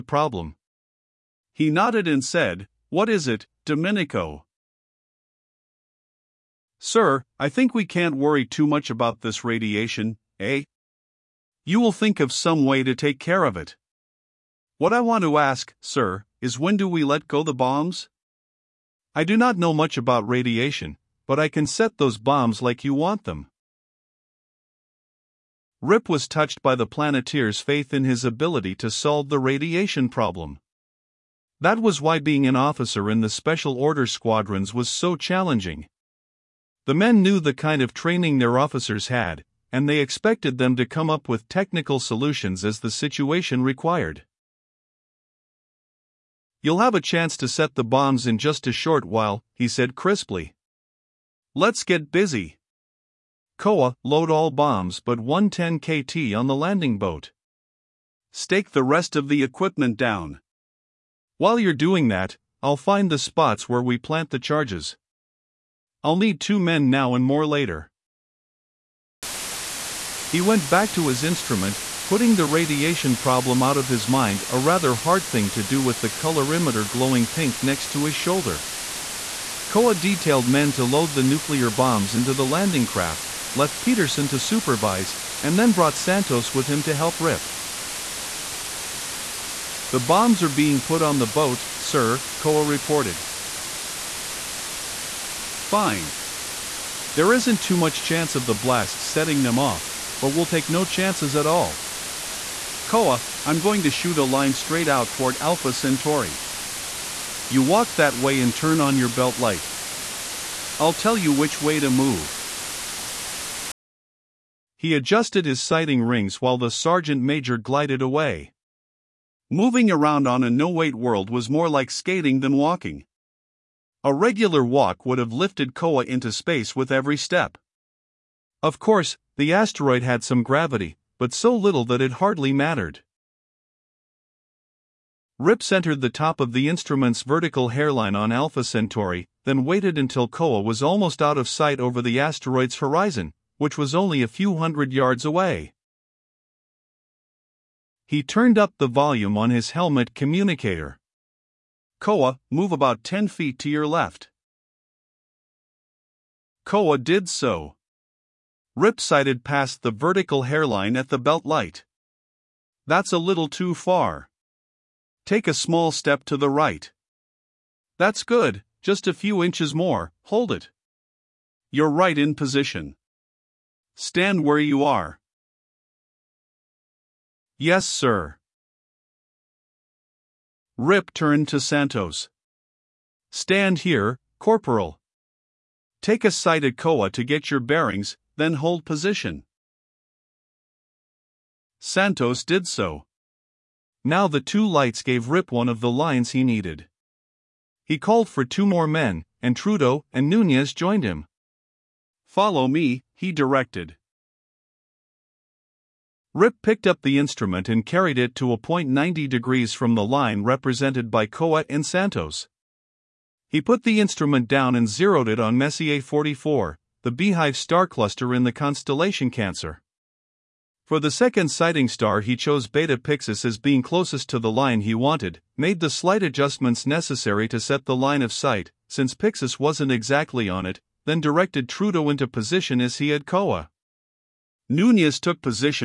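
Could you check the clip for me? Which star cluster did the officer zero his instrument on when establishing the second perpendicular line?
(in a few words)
Messier 44.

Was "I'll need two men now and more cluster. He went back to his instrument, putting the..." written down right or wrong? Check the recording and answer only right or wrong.
wrong.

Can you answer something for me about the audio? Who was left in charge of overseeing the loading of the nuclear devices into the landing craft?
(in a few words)
Peterson.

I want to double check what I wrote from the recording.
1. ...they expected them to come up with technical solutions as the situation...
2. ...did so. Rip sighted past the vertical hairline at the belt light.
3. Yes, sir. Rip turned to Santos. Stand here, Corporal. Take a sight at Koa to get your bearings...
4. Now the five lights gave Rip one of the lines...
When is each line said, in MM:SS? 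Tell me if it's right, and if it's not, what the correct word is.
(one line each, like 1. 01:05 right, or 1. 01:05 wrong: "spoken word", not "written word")
1. 00:39 right
2. 02:36 right
3. 02:57 right
4. 03:14 wrong: "two", not "five".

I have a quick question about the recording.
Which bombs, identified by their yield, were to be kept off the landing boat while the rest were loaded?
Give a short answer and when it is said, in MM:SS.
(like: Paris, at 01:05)
110 KT, at 00:55.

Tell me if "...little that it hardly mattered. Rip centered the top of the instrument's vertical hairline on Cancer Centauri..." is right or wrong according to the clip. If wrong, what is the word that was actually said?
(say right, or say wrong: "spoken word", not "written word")
wrong: "Alpha", not "Cancer".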